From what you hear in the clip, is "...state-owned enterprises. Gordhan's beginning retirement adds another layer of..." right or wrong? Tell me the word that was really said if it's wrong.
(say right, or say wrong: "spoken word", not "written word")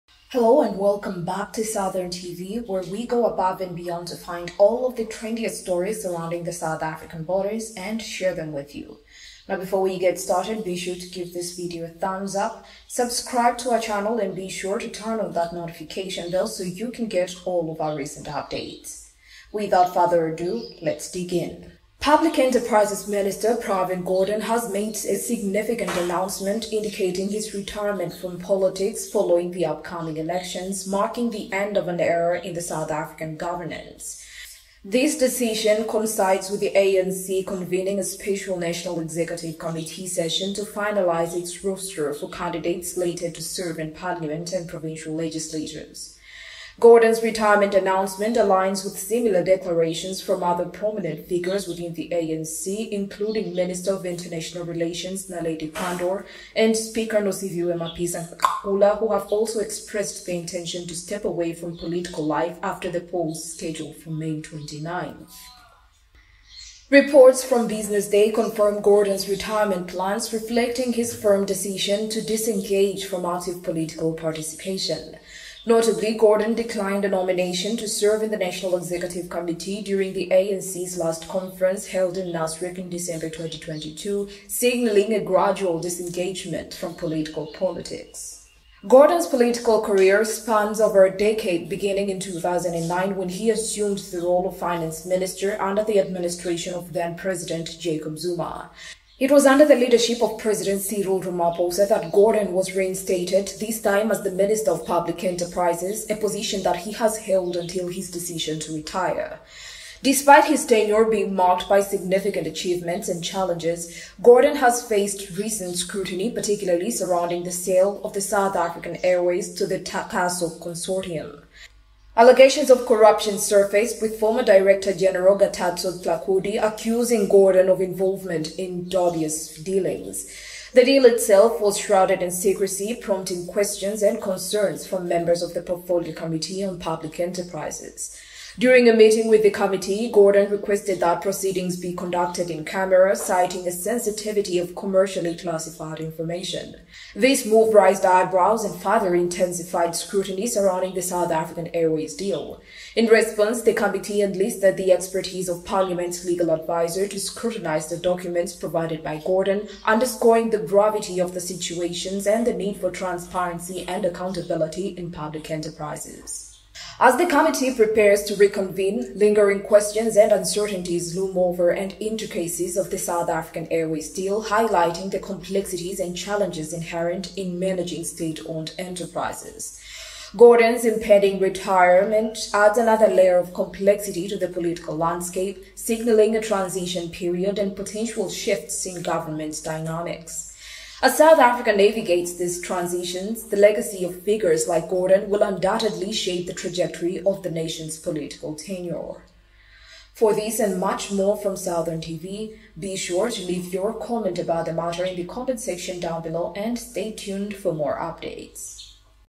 wrong: "impending", not "beginning".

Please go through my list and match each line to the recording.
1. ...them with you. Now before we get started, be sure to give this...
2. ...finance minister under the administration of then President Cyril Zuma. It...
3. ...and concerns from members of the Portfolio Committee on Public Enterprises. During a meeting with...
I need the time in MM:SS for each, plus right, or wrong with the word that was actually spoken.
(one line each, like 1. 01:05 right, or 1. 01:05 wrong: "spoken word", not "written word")
1. 00:08 right
2. 01:34 wrong: "Jacob", not "Cyril"
3. 02:14 right.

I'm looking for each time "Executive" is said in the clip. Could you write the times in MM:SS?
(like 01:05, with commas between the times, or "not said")
00:38, 01:18.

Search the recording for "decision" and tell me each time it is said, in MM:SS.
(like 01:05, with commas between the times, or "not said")
00:35, 01:11, 01:48.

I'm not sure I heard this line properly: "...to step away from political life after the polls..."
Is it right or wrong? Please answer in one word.
right.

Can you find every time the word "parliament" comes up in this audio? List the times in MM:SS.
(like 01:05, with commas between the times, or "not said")
00:43, 02:35.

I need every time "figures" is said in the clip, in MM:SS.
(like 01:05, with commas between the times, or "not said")
00:51, 03:14.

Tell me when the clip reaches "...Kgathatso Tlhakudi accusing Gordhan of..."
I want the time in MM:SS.
02:05.